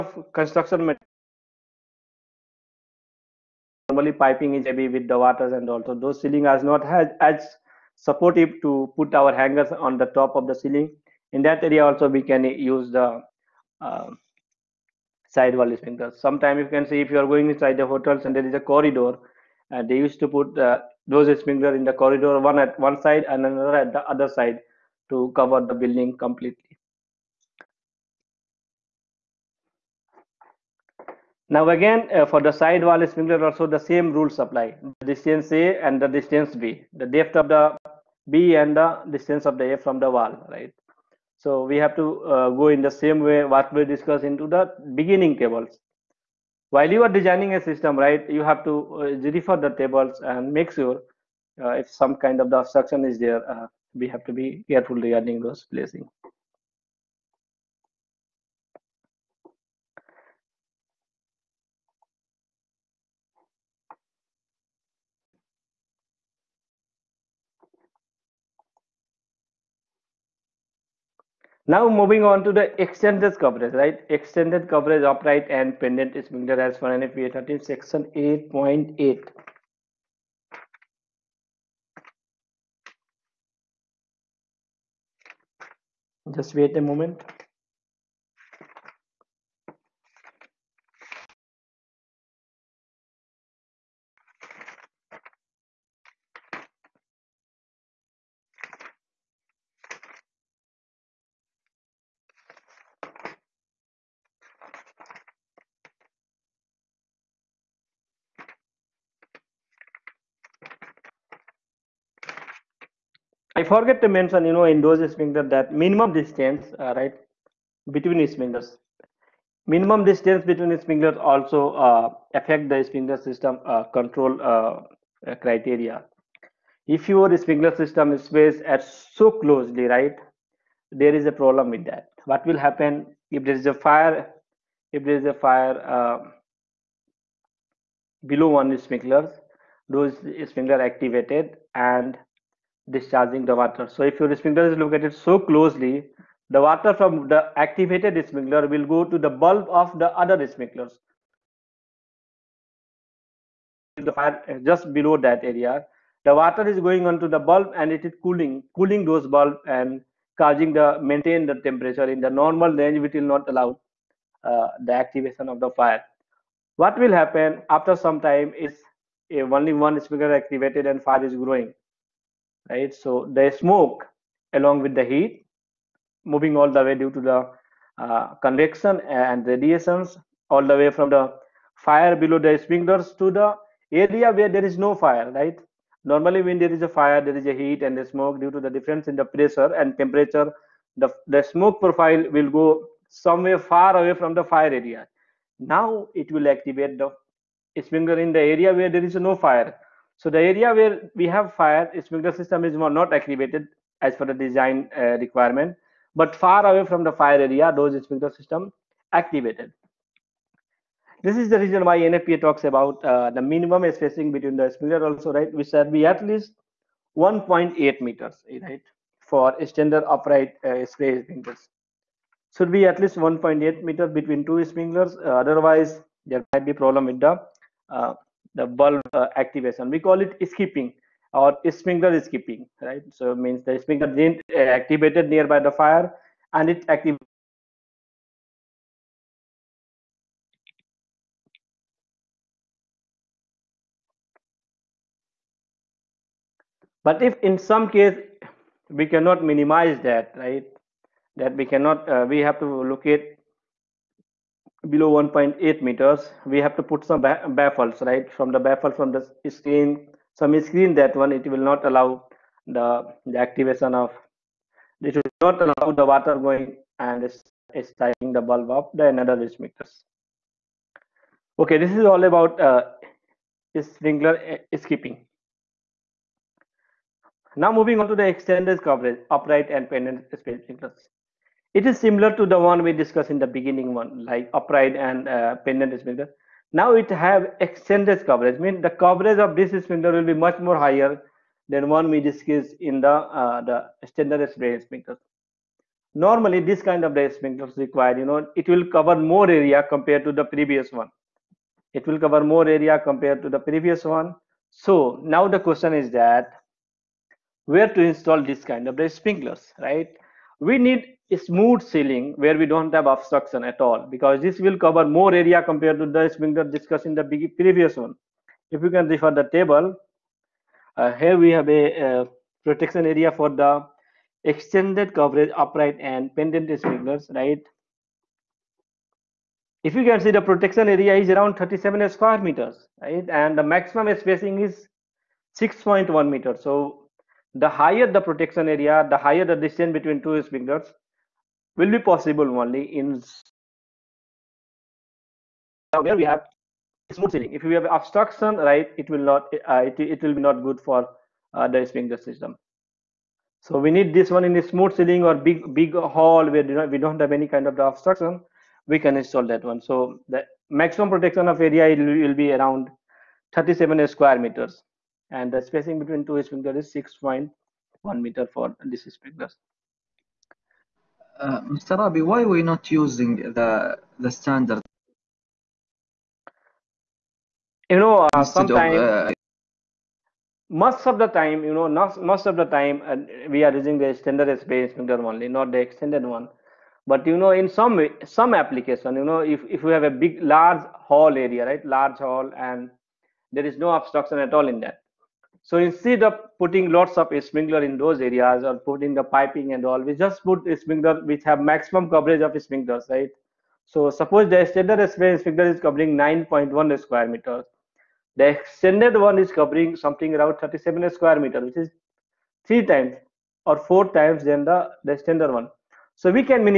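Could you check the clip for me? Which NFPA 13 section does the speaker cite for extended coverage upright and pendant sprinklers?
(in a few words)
8.8.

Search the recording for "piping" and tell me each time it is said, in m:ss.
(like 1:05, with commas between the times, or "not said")
0:04, 6:39.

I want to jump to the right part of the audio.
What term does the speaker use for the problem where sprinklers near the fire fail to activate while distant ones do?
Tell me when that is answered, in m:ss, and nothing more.
3:51.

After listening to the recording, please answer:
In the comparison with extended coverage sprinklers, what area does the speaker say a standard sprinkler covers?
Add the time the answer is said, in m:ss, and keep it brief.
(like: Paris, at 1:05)
9.1 square meters, at 6:46.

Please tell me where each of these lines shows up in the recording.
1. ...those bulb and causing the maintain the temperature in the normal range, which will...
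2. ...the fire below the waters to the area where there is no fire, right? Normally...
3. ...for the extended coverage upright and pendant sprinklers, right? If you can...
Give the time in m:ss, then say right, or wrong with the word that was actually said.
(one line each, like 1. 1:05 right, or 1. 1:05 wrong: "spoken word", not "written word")
1. 2:39 right
2. 3:01 wrong: "sprinklers", not "waters"
3. 5:23 right.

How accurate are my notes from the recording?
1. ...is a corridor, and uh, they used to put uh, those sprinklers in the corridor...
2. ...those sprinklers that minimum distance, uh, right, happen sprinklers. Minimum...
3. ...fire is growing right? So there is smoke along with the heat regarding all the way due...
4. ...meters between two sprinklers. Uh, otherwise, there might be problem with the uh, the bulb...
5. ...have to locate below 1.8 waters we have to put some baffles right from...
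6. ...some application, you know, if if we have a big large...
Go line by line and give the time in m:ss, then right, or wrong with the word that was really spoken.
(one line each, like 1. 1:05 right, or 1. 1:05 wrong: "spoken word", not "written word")
1. 0:18 right
2. 1:54 wrong: "between", not "happen"
3. 2:51 wrong: "moving", not "regarding"
4. 3:43 right
5. 4:12 wrong: "meters", not "waters"
6. 6:28 right.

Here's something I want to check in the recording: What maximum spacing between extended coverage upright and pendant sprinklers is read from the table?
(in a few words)
6.1 meters.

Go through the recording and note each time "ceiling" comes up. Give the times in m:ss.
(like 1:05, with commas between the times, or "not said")
0:06, 0:10, 5:11, 5:47, 5:54.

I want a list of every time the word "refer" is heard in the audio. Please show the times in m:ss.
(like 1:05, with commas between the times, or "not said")
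0:49, 5:19.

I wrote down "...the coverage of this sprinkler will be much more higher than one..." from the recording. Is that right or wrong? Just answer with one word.
right.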